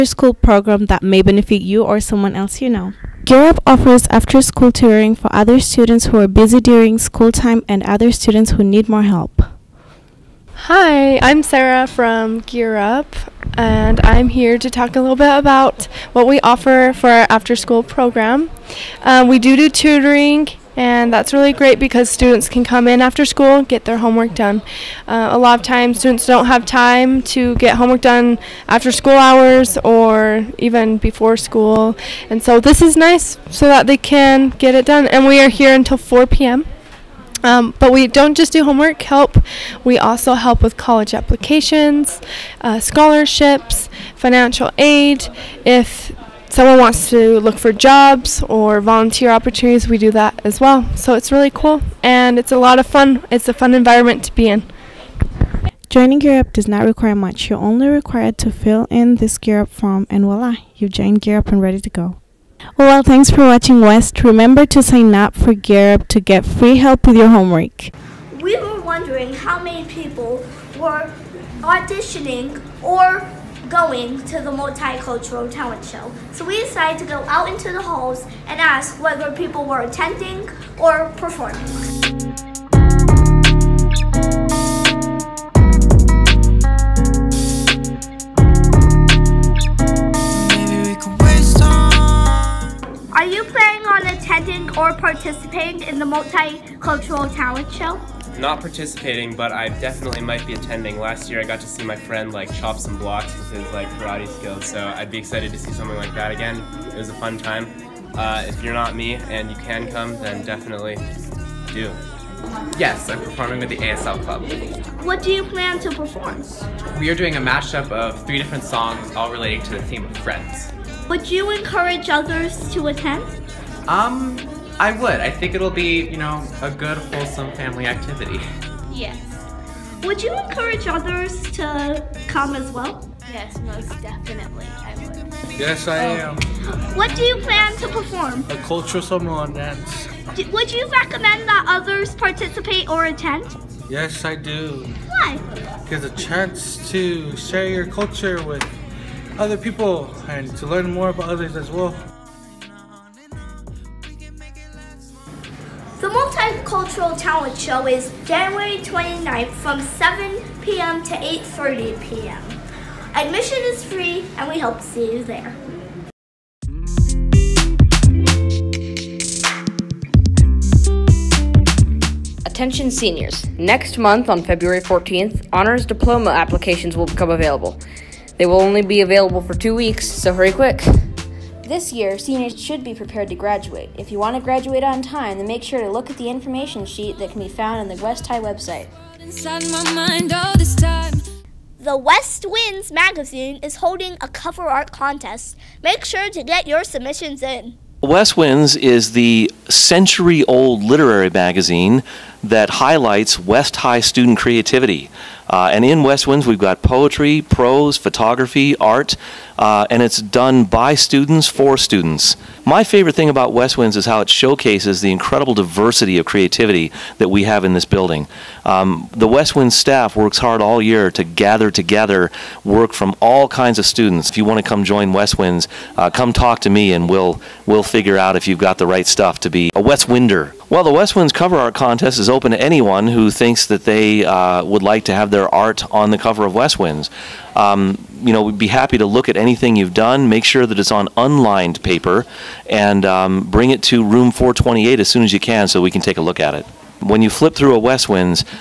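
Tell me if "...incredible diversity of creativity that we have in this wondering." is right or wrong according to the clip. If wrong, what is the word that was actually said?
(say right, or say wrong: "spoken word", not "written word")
wrong: "building", not "wondering".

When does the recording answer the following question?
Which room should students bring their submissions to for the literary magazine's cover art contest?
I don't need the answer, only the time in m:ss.
4:04.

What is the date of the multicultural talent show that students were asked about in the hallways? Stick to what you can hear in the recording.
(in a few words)
January 29th.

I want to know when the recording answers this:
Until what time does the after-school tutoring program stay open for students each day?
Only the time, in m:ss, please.
0:35.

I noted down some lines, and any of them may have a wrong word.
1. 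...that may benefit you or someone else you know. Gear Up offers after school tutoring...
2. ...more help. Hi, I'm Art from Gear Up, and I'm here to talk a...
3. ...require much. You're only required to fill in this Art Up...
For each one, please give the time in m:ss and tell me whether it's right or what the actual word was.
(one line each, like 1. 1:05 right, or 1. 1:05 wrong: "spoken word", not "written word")
1. 0:00 right
2. 0:08 wrong: "Sarah", not "Art"
3. 0:56 wrong: "Gear", not "Art".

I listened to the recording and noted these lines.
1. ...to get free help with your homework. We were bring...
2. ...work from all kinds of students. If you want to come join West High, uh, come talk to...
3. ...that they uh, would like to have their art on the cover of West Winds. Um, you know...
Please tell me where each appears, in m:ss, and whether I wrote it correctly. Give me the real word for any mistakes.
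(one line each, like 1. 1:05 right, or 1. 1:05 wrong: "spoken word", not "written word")
1. 1:06 wrong: "wondering", not "bring"
2. 3:42 wrong: "Winds", not "High"
3. 3:53 right.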